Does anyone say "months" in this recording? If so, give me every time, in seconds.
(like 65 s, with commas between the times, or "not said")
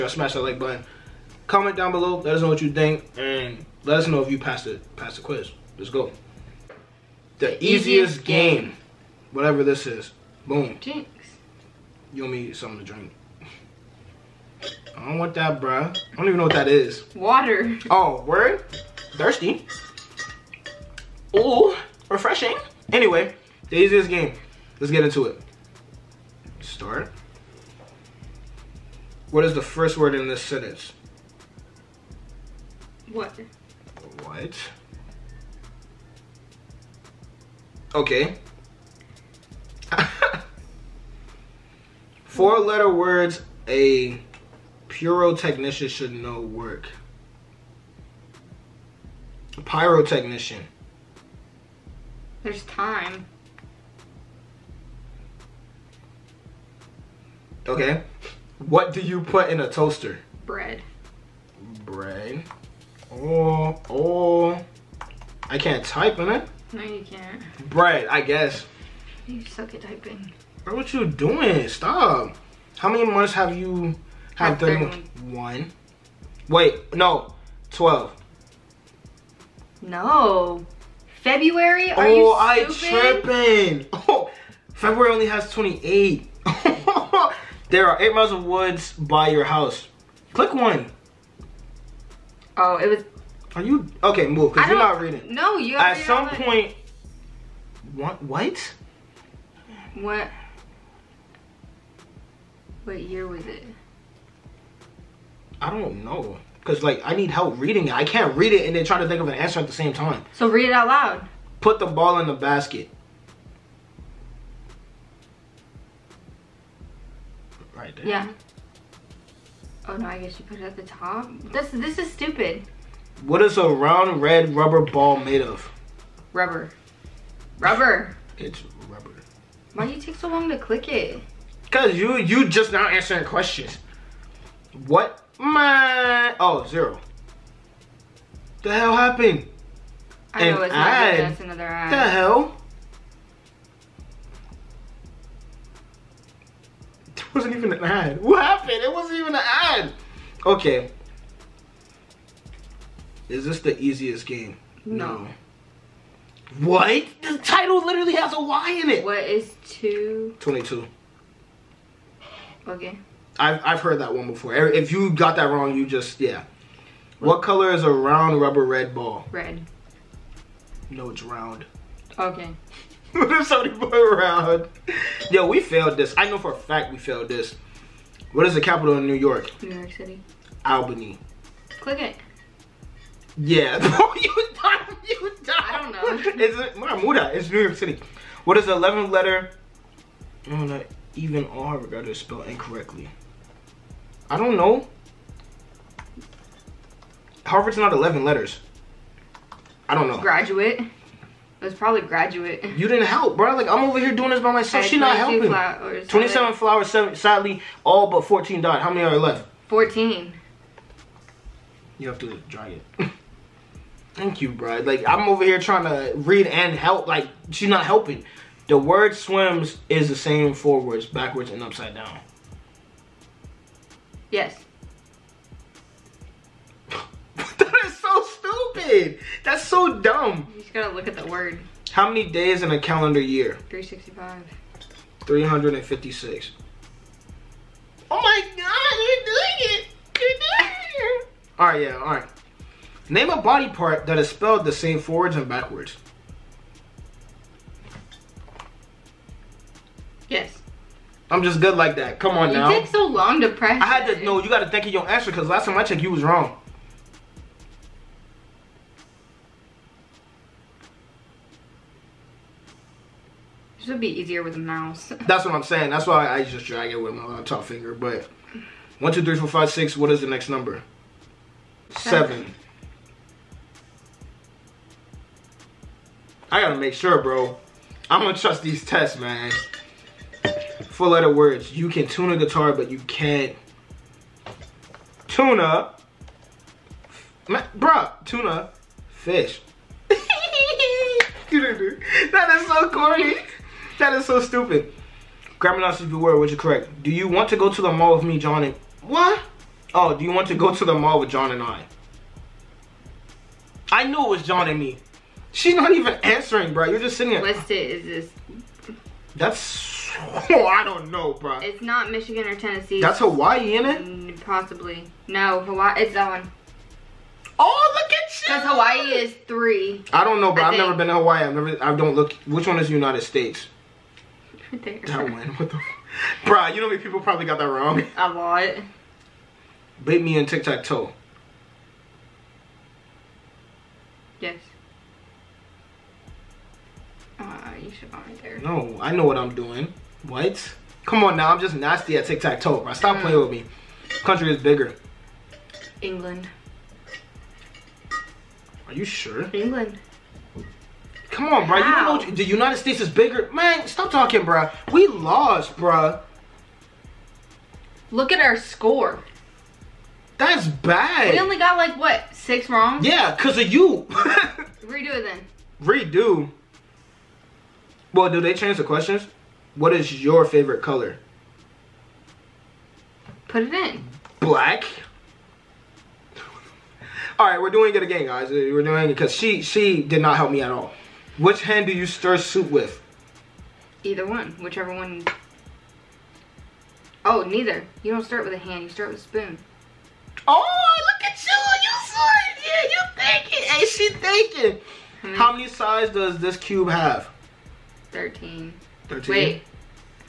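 73 s.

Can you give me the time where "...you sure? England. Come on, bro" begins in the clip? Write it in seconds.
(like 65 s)
348 s.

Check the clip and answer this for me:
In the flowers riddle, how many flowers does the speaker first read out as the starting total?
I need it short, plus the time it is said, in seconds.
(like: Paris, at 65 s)
27, at 206 s.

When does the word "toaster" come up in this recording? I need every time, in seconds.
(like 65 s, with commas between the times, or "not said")
59 s.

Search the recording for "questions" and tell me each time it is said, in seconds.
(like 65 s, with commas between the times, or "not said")
133 s, 368 s.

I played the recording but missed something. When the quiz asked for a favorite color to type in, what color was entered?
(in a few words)
Black.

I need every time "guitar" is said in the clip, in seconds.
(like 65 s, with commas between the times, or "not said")
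282 s.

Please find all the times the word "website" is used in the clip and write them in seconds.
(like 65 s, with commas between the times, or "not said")
not said.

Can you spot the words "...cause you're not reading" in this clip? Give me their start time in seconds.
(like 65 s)
94 s.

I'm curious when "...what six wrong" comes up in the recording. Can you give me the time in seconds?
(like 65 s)
361 s.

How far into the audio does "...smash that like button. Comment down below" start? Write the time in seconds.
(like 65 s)
0 s.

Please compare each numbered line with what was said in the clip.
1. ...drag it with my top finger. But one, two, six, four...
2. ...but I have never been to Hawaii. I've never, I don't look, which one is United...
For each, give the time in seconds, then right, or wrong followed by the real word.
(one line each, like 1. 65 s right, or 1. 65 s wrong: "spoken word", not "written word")
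1. 266 s wrong: "three", not "six"
2. 320 s right.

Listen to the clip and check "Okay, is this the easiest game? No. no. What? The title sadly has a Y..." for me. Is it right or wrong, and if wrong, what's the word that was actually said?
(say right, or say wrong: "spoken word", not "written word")
wrong: "literally", not "sadly".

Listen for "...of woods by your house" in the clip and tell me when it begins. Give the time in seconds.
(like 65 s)
88 s.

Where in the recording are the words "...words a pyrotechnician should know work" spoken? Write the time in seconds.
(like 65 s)
42 s.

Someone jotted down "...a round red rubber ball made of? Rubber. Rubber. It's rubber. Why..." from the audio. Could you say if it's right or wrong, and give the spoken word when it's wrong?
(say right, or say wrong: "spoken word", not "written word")
right.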